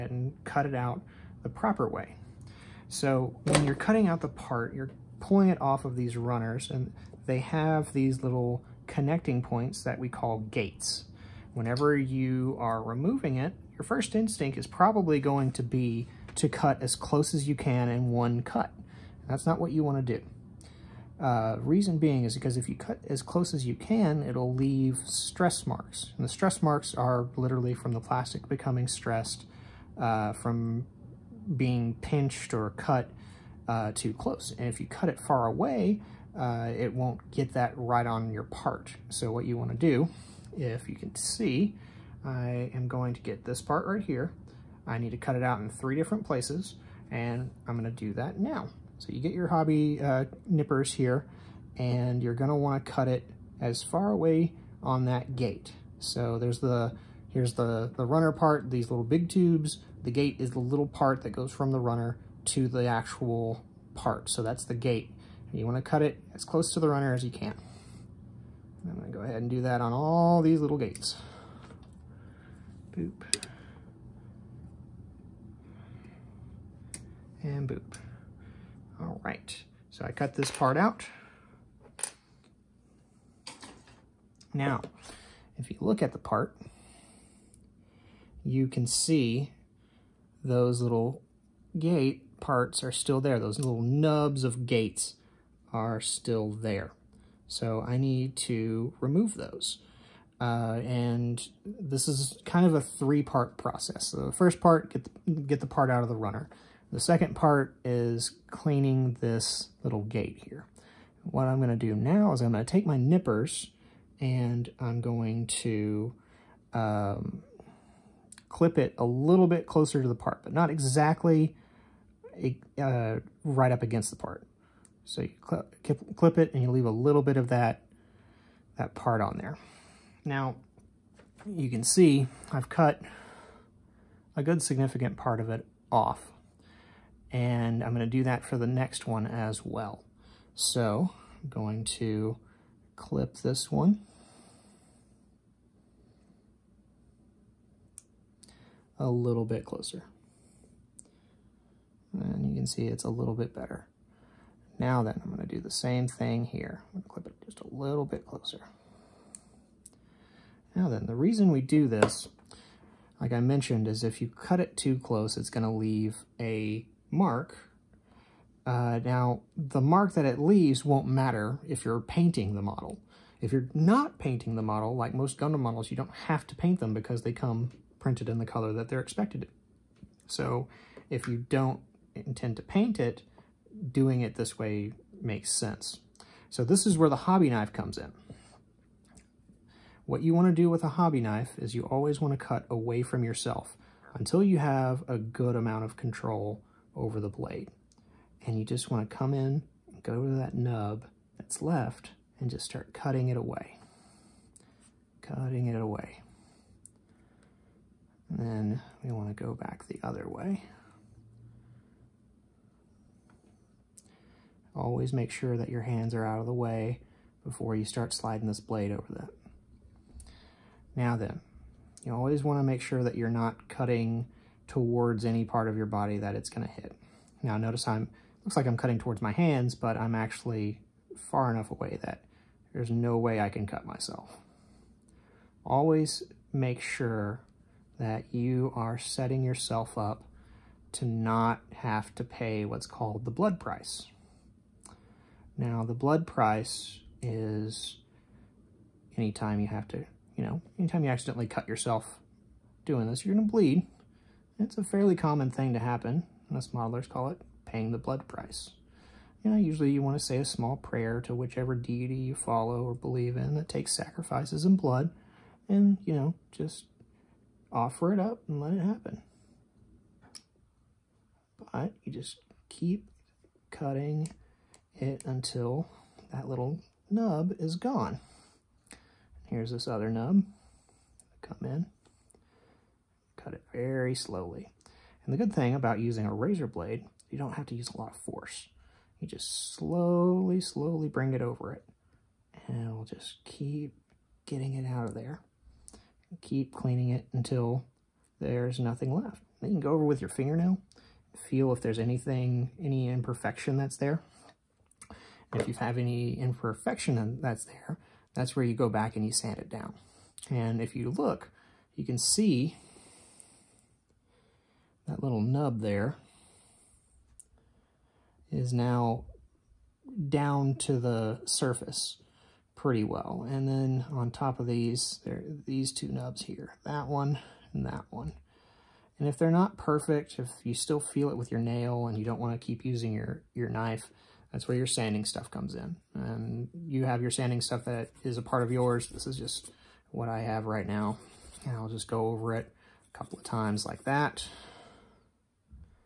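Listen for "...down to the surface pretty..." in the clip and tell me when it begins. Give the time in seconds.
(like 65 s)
320 s.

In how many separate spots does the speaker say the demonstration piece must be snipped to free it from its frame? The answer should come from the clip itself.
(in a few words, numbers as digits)
three.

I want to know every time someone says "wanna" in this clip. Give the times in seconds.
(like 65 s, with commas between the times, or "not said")
52 s, 65 s.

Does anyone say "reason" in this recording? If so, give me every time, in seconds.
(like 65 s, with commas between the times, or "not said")
21 s, 161 s.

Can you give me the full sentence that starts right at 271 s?
But you just keep cutting it until that little nub is gone.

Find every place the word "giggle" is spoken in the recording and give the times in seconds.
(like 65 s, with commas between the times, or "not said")
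not said.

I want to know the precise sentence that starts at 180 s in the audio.
So if you don't intend to paint it, doing it this way makes sense.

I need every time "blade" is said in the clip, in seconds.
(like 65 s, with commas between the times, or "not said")
197 s, 218 s, 286 s.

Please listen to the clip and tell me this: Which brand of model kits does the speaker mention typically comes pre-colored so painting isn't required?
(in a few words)
Gundam.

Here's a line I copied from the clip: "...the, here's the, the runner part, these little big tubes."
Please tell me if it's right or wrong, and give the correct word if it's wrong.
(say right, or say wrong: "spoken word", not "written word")
right.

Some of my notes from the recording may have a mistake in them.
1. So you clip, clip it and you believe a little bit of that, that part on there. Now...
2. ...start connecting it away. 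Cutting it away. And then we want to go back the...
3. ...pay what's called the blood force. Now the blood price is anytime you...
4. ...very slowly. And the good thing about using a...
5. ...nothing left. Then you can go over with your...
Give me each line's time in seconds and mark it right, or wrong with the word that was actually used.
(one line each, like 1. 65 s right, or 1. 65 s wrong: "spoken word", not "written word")
1. 125 s wrong: "leave", not "believe"
2. 202 s wrong: "cutting", not "connecting"
3. 242 s wrong: "price", not "force"
4. 283 s right
5. 298 s right.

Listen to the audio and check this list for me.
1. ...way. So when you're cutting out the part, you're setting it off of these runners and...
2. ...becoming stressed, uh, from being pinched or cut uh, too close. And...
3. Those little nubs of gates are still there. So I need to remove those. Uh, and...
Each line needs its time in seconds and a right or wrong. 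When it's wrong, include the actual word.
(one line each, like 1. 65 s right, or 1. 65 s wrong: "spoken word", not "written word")
1. 1 s wrong: "pulling", not "setting"
2. 28 s right
3. 93 s right.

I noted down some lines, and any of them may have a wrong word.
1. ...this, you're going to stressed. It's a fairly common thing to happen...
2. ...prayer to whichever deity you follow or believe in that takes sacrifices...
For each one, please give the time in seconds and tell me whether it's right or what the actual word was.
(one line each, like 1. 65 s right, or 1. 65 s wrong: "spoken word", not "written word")
1. 253 s wrong: "bleed", not "stressed"
2. 260 s right.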